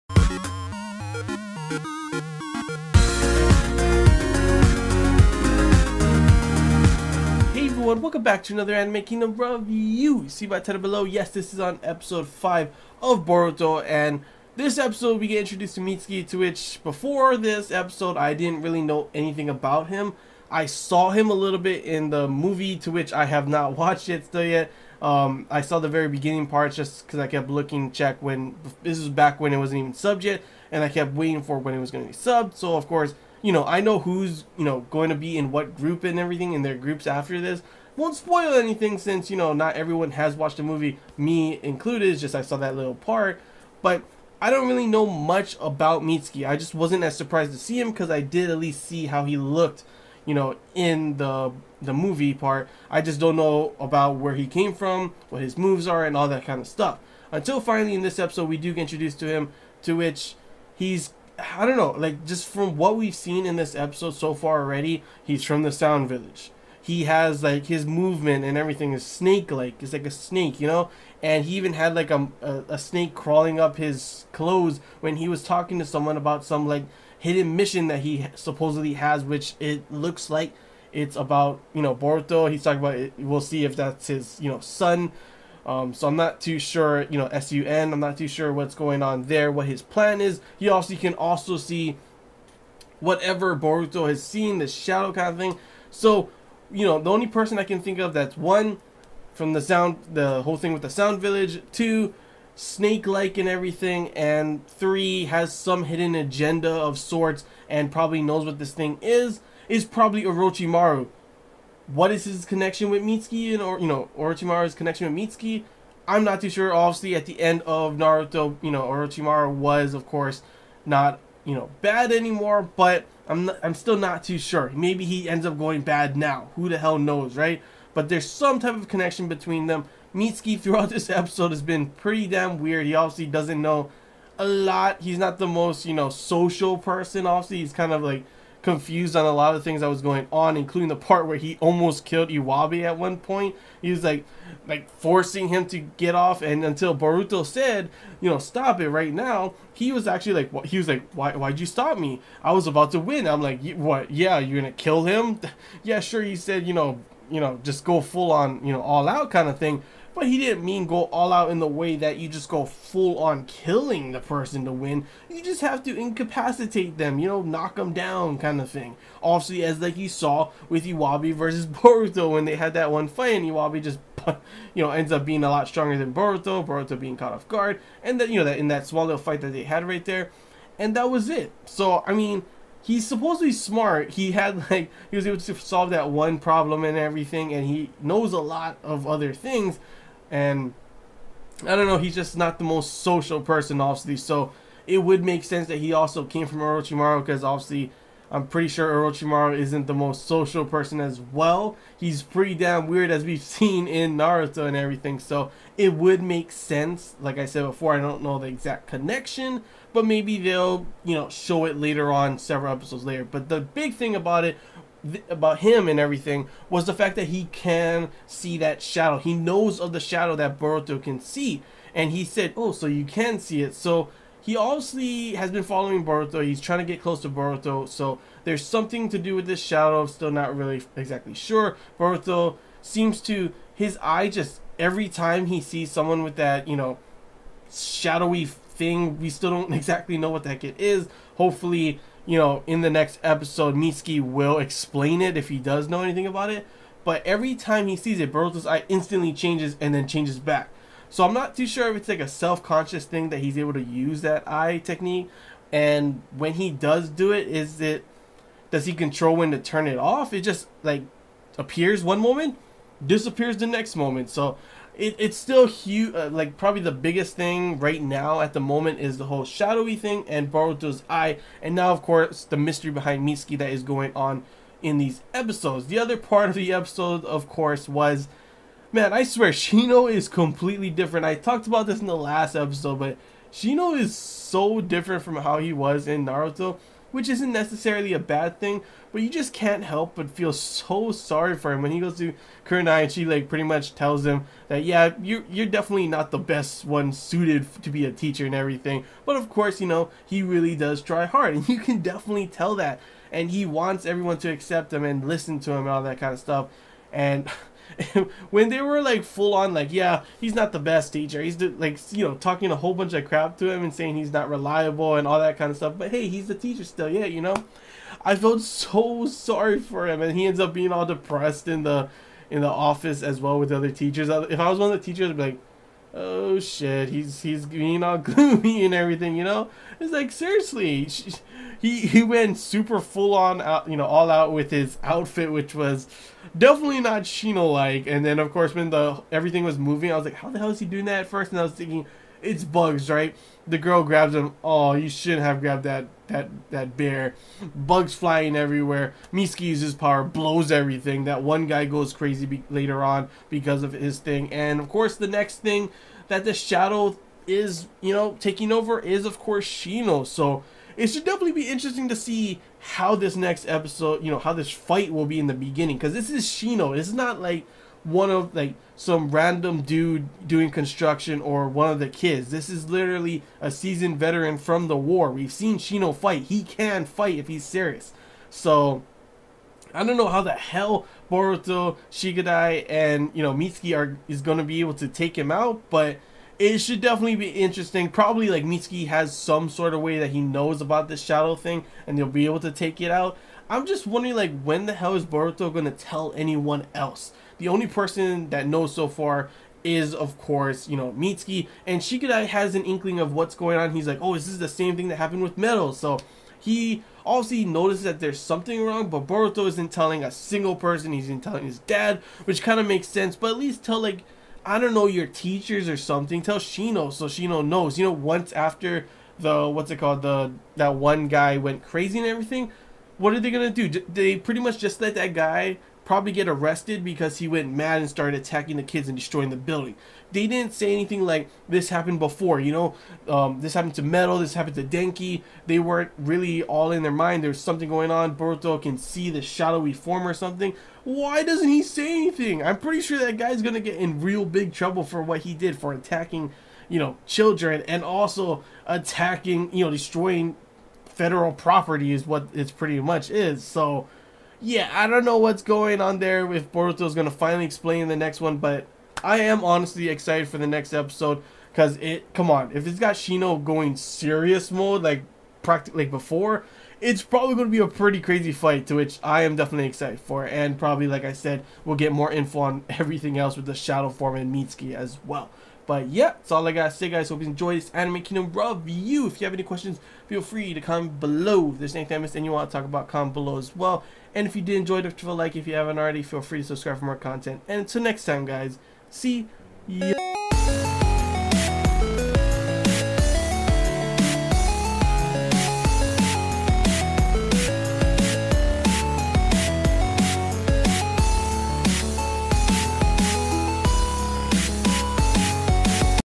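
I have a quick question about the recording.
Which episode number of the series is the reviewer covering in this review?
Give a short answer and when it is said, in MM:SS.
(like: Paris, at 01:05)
5, at 00:11.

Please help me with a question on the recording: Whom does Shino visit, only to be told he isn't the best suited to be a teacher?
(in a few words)
Kurenai.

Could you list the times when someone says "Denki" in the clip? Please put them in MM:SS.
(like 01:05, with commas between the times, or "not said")
07:14.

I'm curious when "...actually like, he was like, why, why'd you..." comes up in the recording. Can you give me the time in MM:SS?
02:30.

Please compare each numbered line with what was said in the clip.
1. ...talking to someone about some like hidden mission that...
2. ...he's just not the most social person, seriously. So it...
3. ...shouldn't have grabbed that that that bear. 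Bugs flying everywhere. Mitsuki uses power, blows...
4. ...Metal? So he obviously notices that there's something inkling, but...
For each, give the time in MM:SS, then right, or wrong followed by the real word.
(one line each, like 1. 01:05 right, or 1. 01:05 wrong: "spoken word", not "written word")
1. 01:15 right
2. 03:11 wrong: "obviously", not "seriously"
3. 05:45 right
4. 06:45 wrong: "wrong", not "inkling".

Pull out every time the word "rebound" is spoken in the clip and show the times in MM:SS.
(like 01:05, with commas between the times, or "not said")
not said.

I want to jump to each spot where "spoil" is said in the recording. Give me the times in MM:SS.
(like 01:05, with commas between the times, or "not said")
00:38.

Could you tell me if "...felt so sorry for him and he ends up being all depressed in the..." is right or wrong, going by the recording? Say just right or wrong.
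right.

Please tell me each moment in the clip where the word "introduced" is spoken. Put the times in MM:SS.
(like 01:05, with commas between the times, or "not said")
00:15, 00:58.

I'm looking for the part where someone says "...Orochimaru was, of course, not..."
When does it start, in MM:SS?
01:58.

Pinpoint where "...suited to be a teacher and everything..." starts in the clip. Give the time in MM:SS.
04:57.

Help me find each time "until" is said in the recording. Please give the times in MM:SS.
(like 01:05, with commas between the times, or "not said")
00:57, 02:26, 08:07.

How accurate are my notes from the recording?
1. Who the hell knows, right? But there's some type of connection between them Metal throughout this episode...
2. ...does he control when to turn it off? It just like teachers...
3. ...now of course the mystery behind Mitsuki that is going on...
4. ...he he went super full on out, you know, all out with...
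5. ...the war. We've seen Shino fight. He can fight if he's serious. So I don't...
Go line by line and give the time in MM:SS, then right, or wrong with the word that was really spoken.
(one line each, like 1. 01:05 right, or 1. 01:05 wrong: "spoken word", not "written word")
1. 02:06 wrong: "Mitsuki", not "Metal"
2. 04:18 wrong: "appears", not "teachers"
3. 04:31 right
4. 05:31 right
5. 06:14 right.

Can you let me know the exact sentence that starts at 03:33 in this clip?
But the big thing about it th- about him and everything was the fact that he can see that shadow.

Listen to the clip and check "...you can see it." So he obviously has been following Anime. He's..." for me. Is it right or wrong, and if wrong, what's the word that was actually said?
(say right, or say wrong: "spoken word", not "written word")
wrong: "Boruto", not "Anime".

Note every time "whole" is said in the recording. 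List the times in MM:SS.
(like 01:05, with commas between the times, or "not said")
01:40, 04:29, 05:12.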